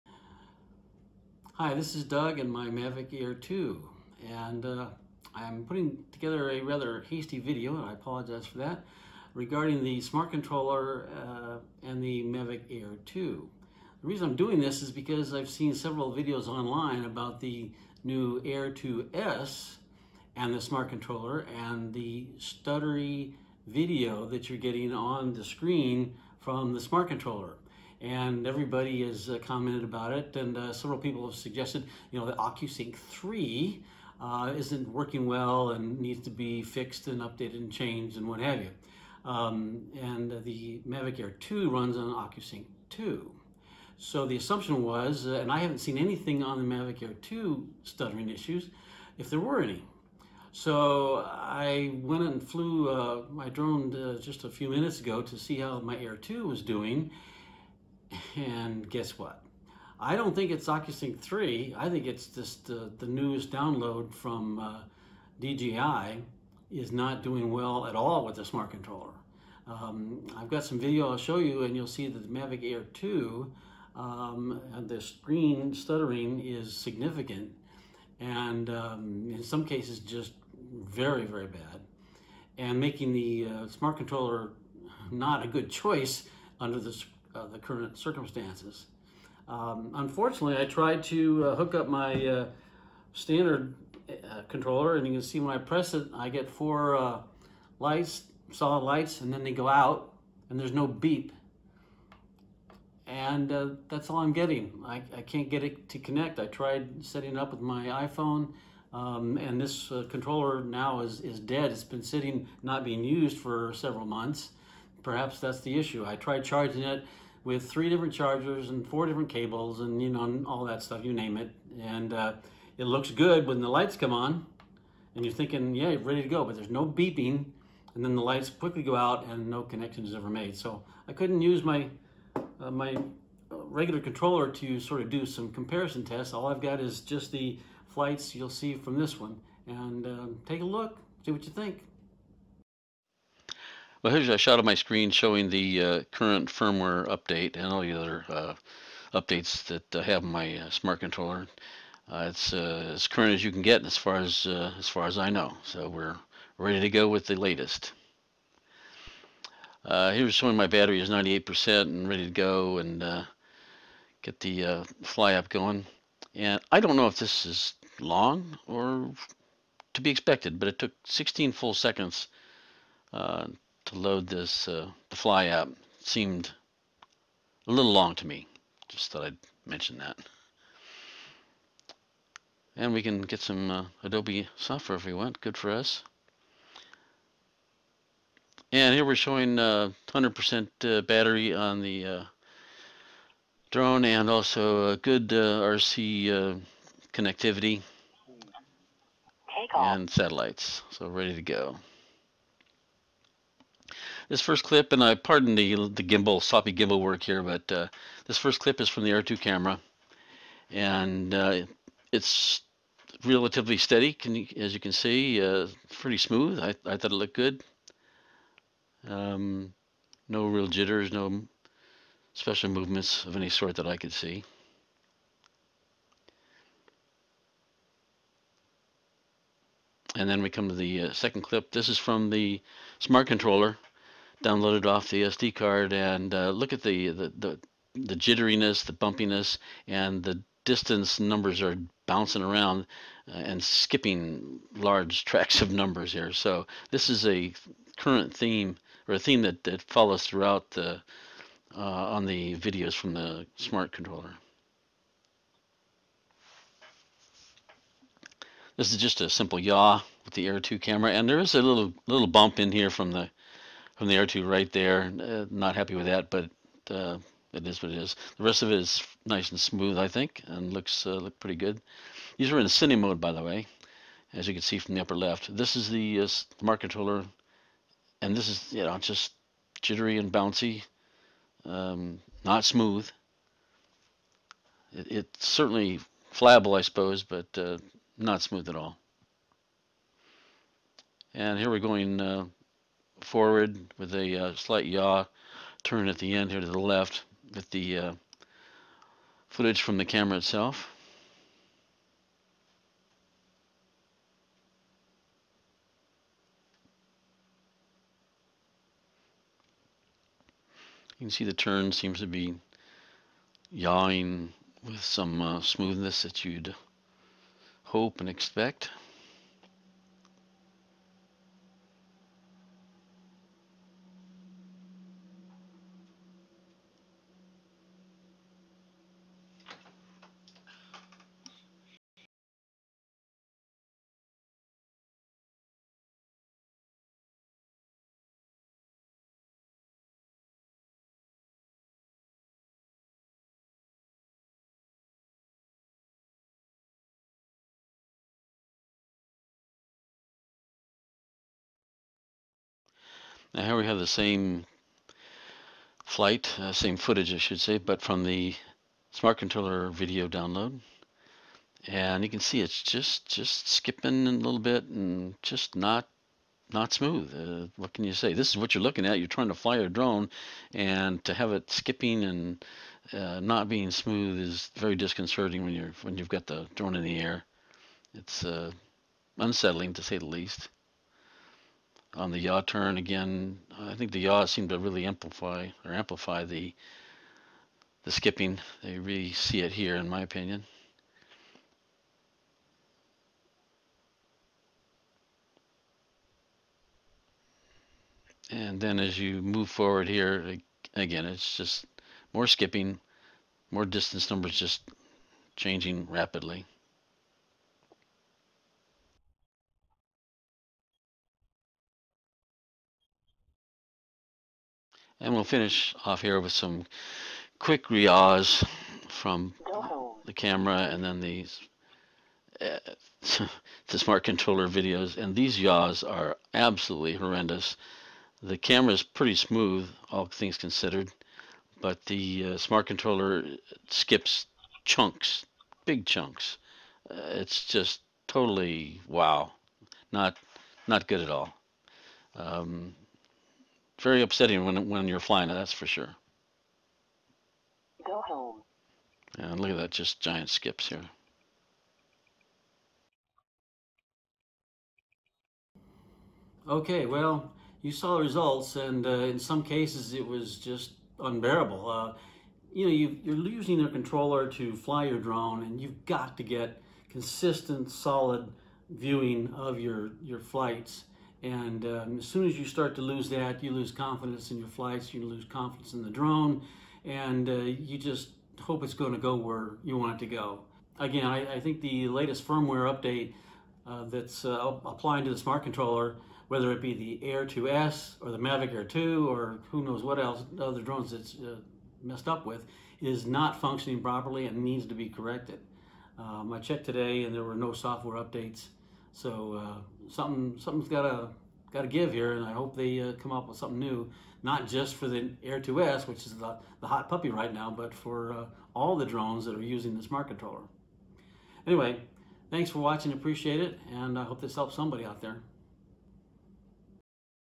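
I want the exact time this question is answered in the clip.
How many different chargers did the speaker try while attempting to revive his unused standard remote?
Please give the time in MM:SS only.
01:57.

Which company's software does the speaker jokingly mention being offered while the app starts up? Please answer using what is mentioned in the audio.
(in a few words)
Adobe.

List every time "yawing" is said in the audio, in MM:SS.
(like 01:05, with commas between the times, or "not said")
05:13.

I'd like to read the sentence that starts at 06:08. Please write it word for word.
This is what you're looking at.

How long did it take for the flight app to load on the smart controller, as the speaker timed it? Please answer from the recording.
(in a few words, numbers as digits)
16 seconds.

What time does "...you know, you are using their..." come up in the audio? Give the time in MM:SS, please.
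07:42.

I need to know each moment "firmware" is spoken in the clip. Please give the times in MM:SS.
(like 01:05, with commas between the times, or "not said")
02:26, 08:02.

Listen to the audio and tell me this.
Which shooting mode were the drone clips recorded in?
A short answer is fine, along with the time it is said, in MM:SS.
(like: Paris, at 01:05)
cine mode, at 04:32.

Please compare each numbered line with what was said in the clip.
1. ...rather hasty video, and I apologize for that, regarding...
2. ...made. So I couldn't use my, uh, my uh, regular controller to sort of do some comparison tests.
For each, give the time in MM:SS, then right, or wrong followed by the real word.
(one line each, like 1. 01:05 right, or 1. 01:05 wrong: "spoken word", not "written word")
1. 00:06 right
2. 02:10 right.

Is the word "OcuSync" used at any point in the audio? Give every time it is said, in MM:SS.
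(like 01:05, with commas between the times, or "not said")
00:32, 00:42, 01:00.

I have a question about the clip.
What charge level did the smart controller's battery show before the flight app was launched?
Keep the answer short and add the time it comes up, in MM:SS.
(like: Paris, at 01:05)
98%, at 02:41.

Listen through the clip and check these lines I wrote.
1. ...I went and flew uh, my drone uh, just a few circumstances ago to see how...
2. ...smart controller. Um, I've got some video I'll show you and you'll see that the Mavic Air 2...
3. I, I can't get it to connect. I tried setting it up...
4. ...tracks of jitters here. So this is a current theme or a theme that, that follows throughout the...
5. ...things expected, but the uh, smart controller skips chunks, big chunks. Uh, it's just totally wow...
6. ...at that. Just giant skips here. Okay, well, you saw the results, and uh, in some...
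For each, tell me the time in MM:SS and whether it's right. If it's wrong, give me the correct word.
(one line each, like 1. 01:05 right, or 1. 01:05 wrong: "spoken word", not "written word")
1. 00:51 wrong: "minutes", not "circumstances"
2. 01:08 right
3. 01:44 right
4. 04:05 wrong: "numbers", not "jitters"
5. 07:10 wrong: "considered", not "expected"
6. 07:29 right.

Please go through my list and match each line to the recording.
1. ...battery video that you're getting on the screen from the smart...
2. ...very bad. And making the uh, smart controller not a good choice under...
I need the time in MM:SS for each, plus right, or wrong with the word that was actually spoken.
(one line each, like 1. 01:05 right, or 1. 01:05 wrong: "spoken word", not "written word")
1. 00:22 wrong: "stuttery", not "battery"
2. 01:21 right.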